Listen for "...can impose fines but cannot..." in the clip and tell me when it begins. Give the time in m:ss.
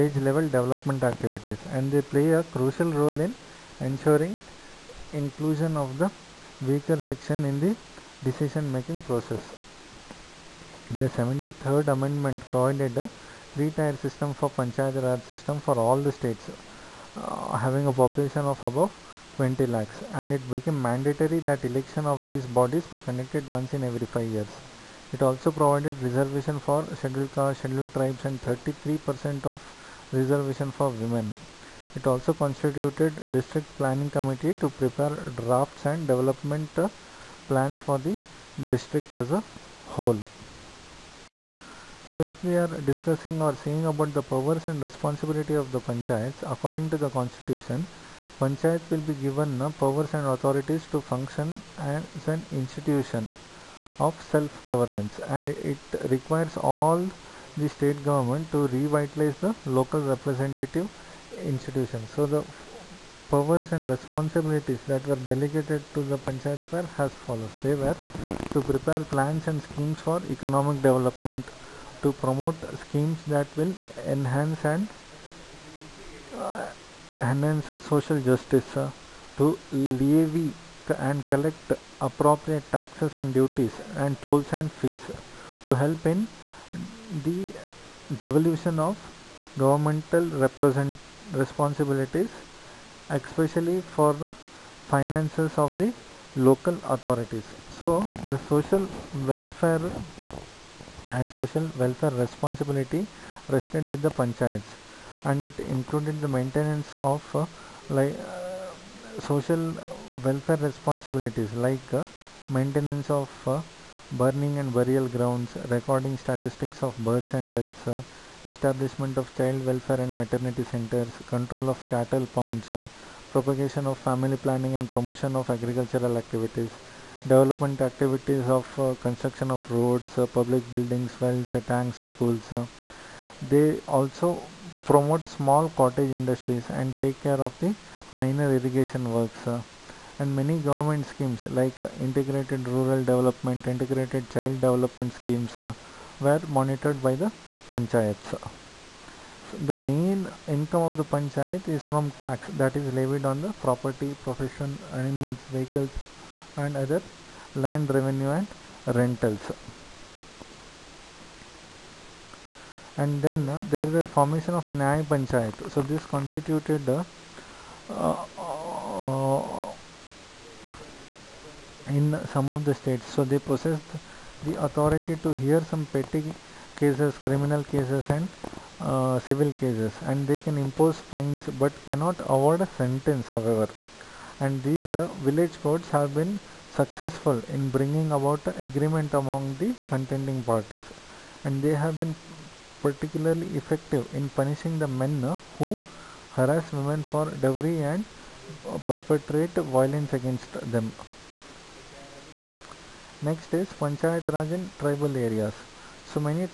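3:00.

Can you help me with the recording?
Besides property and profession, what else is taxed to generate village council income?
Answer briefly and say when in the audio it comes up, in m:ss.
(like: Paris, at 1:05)
Animals, at 2:34.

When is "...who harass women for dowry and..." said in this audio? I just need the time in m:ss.
3:15.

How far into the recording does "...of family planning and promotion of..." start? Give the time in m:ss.
2:03.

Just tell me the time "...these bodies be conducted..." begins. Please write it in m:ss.
0:22.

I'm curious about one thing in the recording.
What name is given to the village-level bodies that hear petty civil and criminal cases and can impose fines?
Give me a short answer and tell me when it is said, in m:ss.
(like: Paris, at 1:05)
Nyay Panchayat, at 2:44.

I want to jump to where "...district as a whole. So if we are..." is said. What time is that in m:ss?
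0:38.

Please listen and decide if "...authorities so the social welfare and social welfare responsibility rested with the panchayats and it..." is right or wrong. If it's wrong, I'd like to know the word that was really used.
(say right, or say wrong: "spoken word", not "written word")
right.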